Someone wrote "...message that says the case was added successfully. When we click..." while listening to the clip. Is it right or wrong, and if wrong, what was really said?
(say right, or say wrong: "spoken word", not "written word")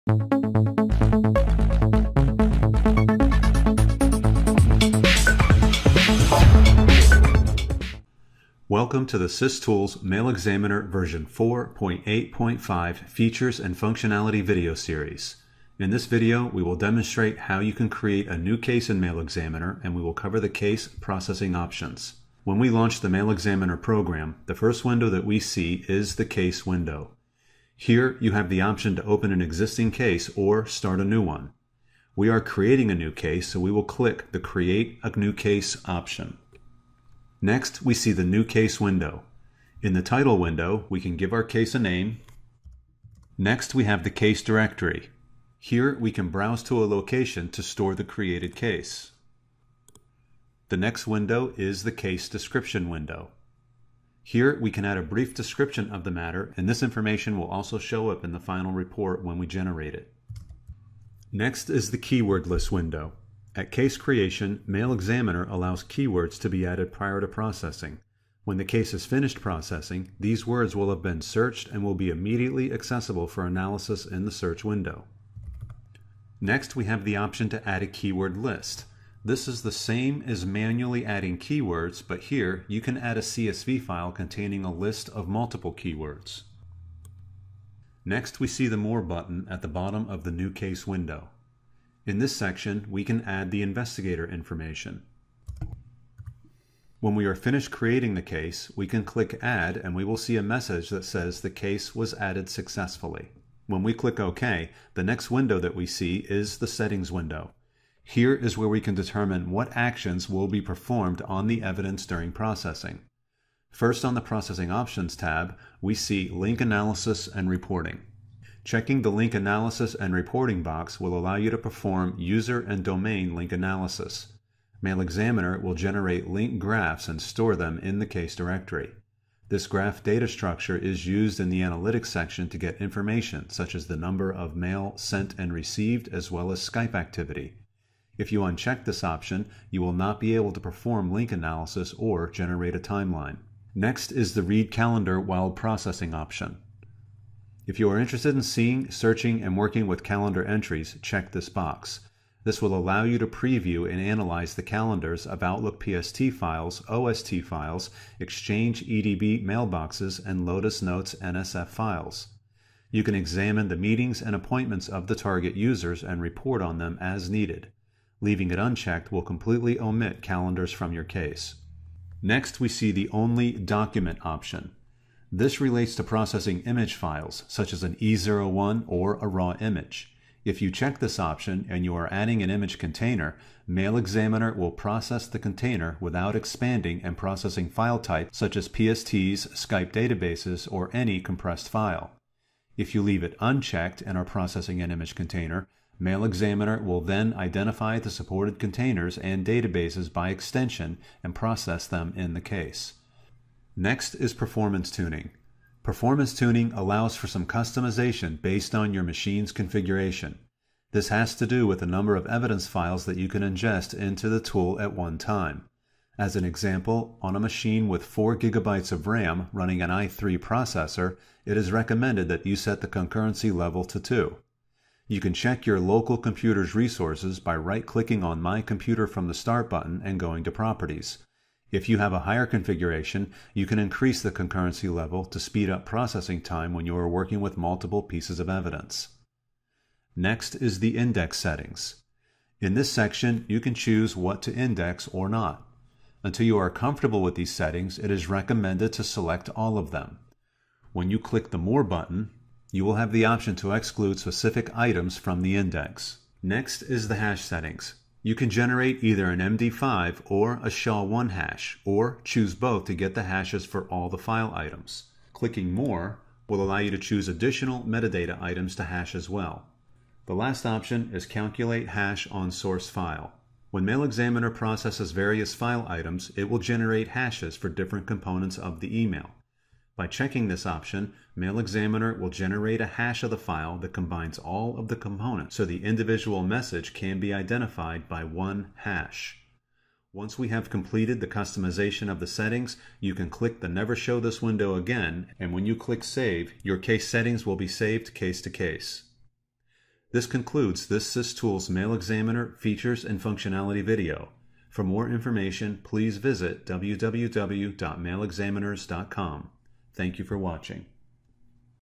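right.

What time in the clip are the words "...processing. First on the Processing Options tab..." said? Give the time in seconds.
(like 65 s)
112 s.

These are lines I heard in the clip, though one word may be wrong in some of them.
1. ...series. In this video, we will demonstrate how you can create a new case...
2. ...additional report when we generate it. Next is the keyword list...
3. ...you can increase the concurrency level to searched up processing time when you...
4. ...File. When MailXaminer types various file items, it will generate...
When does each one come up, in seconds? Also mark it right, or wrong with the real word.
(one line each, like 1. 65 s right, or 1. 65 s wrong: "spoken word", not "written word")
1. 14 s right
2. 58 s wrong: "final", not "additional"
3. 233 s wrong: "speed", not "searched"
4. 272 s wrong: "processes", not "types".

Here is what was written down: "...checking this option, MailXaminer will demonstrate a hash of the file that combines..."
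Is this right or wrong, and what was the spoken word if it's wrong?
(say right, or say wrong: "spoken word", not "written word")
wrong: "generate", not "demonstrate".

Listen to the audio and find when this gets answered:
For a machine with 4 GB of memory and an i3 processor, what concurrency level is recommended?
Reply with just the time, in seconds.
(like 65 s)
223 s.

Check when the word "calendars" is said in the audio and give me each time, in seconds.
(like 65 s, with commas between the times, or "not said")
144 s, 150 s, 154 s, 170 s.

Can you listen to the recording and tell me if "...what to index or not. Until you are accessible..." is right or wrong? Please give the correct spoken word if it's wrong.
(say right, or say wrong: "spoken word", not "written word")
wrong: "comfortable", not "accessible".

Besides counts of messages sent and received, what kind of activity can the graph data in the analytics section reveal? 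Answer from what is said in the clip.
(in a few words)
Skype activity.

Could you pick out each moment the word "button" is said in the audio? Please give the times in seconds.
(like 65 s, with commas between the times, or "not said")
89 s, 229 s, 251 s.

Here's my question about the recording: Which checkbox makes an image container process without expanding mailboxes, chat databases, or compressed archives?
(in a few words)
Only Document.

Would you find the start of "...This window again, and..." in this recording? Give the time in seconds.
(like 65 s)
294 s.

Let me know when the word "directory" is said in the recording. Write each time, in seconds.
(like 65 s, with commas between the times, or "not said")
44 s, 128 s.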